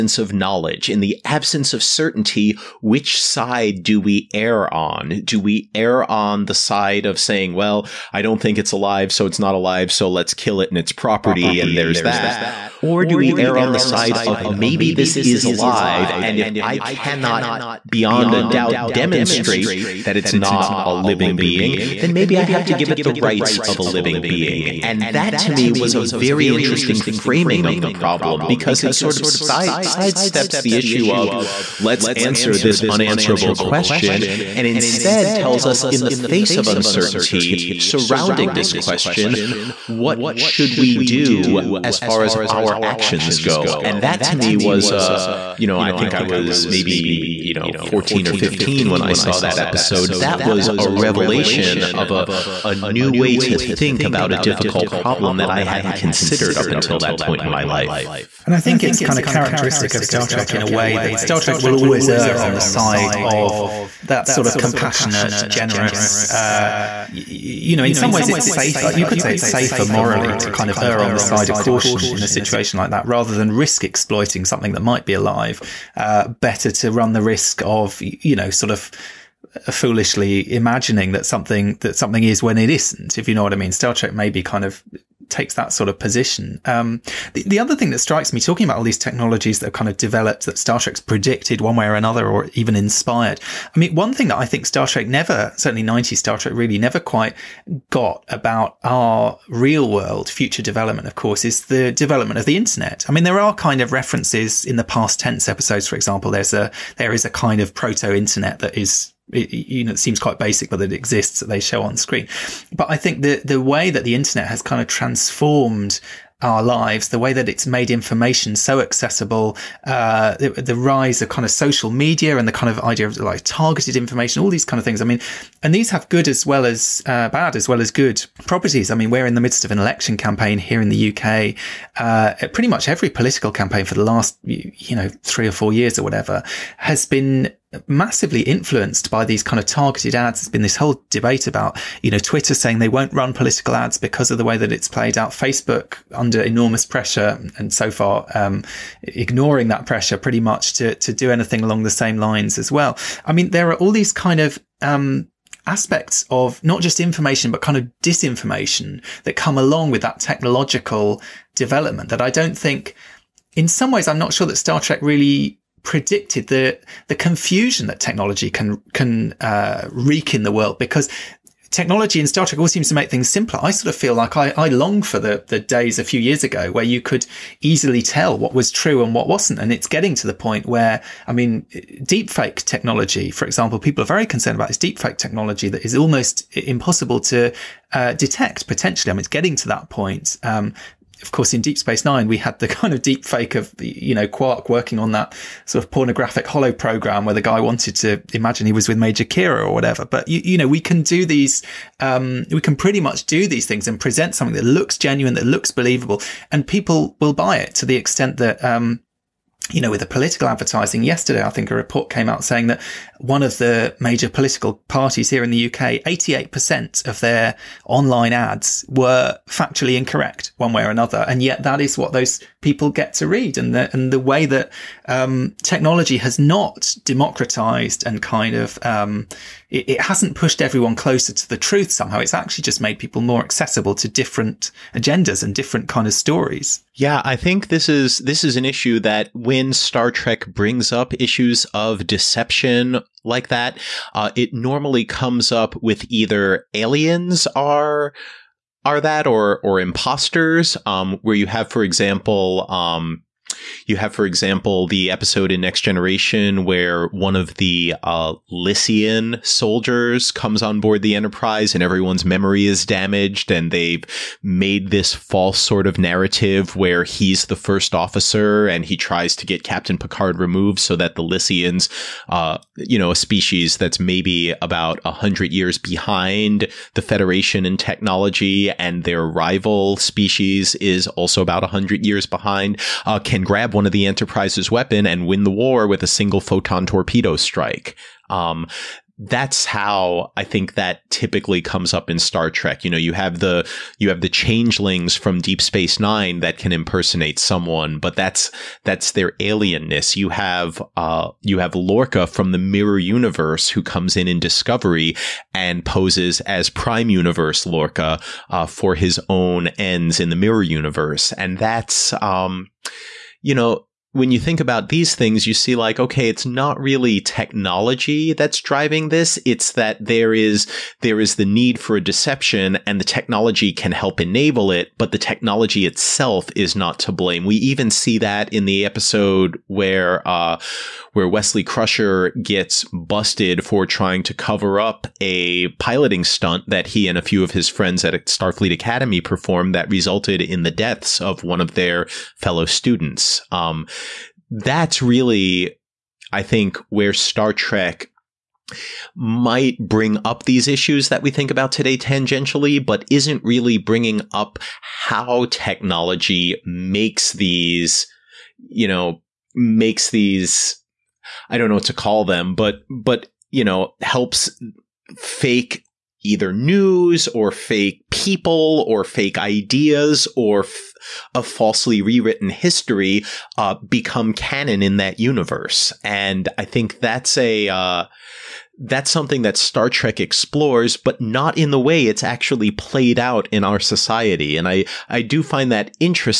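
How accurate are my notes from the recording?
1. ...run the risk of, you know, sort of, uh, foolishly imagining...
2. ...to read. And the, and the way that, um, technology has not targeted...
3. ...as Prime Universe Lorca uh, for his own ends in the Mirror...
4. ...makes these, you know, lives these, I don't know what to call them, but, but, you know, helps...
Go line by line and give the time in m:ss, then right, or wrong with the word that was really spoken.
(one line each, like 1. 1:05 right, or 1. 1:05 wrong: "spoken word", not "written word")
1. 1:16 right
2. 3:43 wrong: "democratized", not "targeted"
3. 5:06 right
4. 5:56 wrong: "makes", not "lives".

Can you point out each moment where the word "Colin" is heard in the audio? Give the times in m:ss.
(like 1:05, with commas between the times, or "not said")
not said.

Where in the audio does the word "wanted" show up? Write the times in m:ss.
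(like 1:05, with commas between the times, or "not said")
3:17.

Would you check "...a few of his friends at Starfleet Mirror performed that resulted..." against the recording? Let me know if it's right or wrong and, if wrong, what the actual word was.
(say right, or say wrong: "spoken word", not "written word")
wrong: "Academy", not "Mirror".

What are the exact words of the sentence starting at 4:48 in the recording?
Um, that's how I think that typically comes up in Star Trek.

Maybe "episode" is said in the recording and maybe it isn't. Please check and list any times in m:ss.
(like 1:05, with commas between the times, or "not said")
0:49, 1:45, 4:15, 5:28.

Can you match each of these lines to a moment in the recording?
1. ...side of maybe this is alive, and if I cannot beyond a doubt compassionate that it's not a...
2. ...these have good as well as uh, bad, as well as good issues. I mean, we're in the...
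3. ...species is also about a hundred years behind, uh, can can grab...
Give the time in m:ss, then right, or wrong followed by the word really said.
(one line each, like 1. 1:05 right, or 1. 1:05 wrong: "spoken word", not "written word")
1. 0:13 wrong: "demonstrate", not "compassionate"
2. 2:05 wrong: "properties", not "issues"
3. 4:39 right.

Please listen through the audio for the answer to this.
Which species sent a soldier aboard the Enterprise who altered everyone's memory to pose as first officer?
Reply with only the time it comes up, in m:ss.
4:18.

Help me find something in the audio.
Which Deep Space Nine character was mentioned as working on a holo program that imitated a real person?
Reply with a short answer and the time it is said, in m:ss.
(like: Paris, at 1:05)
Quark, at 3:14.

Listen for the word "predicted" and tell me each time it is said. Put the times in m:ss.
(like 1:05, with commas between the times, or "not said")
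1:30, 2:45.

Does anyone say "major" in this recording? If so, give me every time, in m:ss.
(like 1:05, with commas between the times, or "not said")
3:18, 3:33.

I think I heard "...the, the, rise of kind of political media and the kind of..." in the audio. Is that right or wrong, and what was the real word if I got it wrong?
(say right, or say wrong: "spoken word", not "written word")
wrong: "social", not "political".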